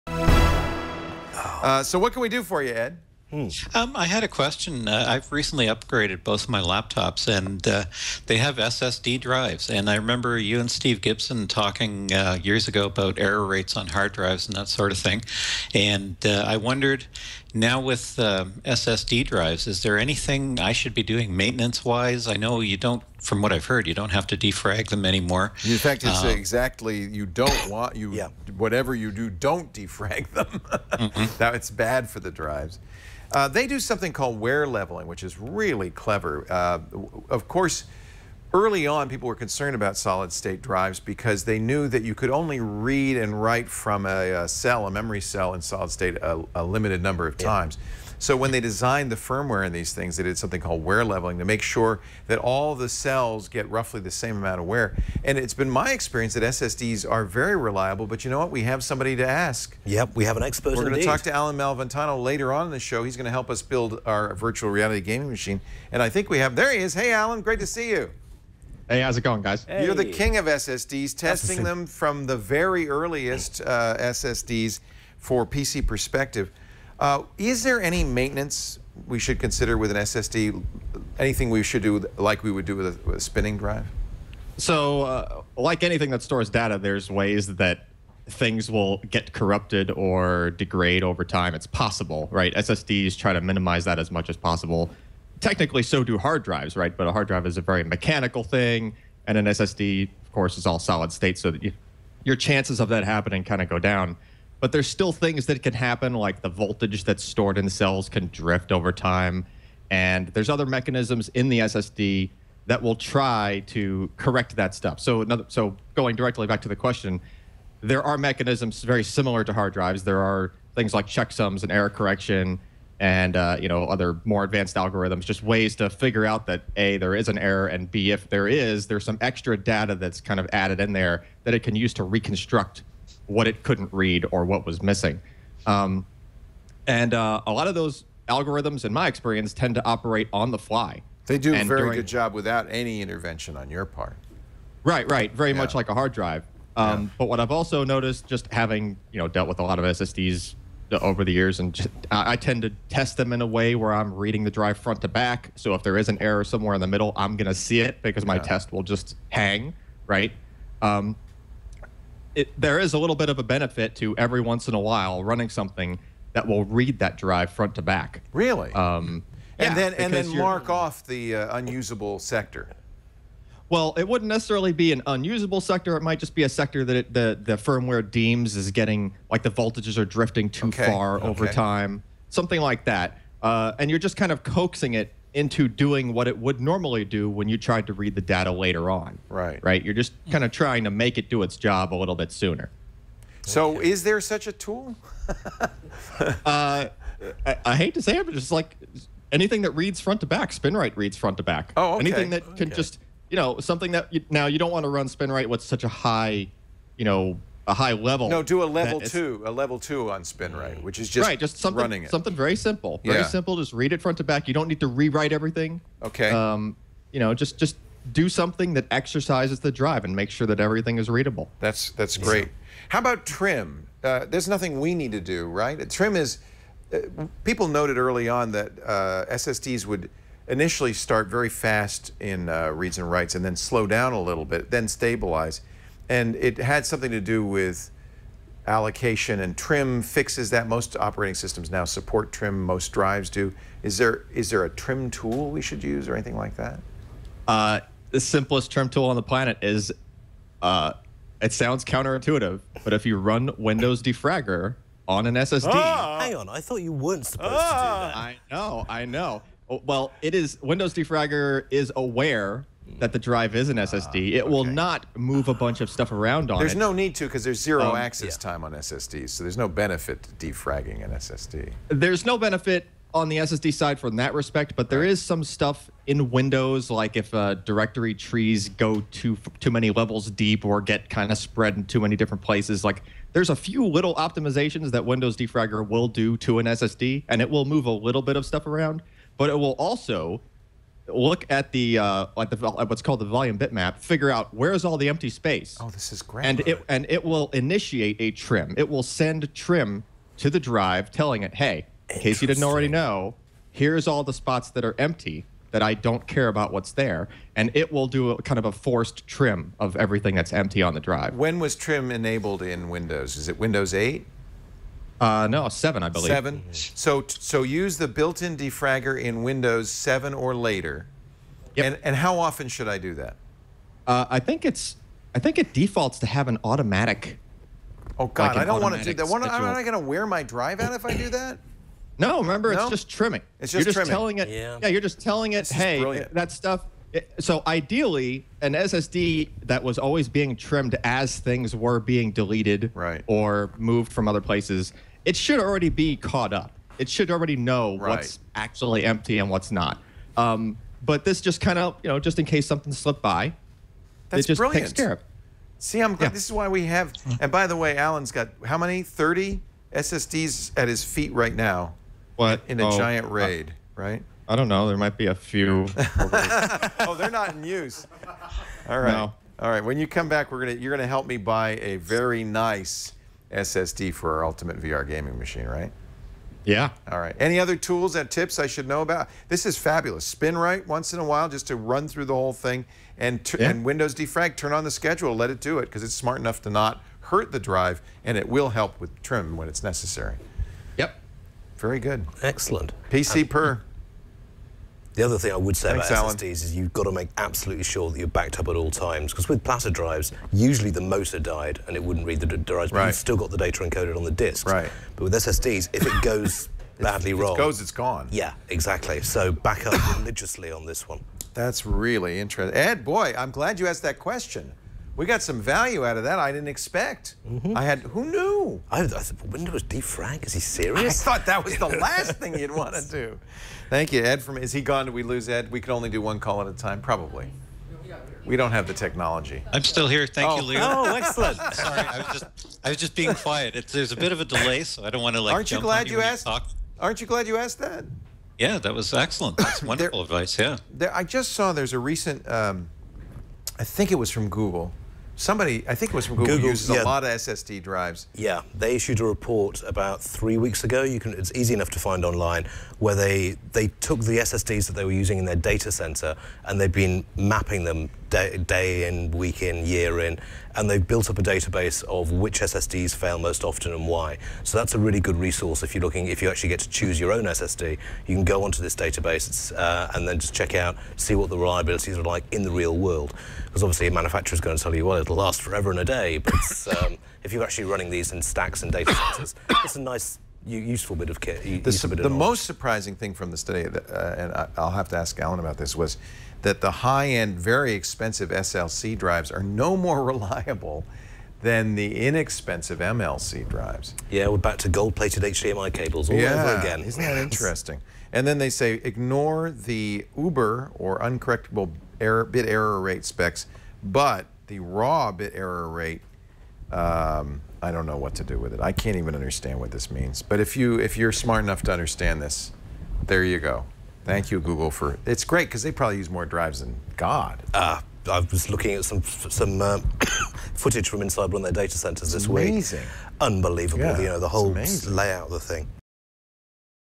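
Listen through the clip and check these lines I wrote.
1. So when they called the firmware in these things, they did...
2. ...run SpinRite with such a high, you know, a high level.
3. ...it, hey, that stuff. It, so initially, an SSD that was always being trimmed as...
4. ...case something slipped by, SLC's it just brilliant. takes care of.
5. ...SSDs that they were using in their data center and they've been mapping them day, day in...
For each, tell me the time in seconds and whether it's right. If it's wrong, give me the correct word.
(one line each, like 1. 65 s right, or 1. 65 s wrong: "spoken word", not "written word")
1. 48 s wrong: "designed", not "called"
2. 204 s right
3. 335 s wrong: "ideally", not "initially"
4. 352 s wrong: "That", not "SLC"
5. 454 s right.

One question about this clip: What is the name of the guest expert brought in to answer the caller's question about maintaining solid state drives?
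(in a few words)
Allyn Malventano.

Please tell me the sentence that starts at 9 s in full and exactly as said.
And I remember you and Steve Gibson talking uh, years ago about error rates on hard drives and that sort of thing.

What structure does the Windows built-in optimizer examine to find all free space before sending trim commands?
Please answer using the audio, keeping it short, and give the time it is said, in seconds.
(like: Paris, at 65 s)
volume bitmap, at 293 s.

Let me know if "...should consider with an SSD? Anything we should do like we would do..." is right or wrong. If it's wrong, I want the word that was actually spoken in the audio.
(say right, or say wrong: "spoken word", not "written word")
right.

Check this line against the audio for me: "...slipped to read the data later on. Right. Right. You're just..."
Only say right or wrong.
wrong.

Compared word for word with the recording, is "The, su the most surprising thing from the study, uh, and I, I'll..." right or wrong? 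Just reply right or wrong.
right.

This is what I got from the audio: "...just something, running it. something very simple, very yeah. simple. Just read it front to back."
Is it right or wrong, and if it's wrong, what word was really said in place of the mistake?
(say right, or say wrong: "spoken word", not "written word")
right.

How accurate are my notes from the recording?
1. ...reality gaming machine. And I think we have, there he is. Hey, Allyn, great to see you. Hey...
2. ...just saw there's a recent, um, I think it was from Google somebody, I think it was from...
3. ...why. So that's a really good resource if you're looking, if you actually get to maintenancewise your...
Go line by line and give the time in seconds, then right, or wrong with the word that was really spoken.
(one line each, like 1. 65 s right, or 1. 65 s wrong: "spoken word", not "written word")
1. 64 s right
2. 441 s right
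3. 464 s wrong: "choose", not "maintenancewise".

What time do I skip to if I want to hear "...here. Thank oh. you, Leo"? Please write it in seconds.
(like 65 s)
430 s.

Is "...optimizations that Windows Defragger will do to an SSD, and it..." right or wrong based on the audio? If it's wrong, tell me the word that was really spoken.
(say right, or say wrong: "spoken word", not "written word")
right.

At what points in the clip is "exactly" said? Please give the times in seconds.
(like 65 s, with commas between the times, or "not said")
26 s, 408 s.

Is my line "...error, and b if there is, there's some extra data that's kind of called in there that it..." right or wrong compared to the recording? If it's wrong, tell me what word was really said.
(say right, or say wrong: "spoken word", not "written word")
wrong: "added", not "called".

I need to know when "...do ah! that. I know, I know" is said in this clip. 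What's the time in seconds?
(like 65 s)
257 s.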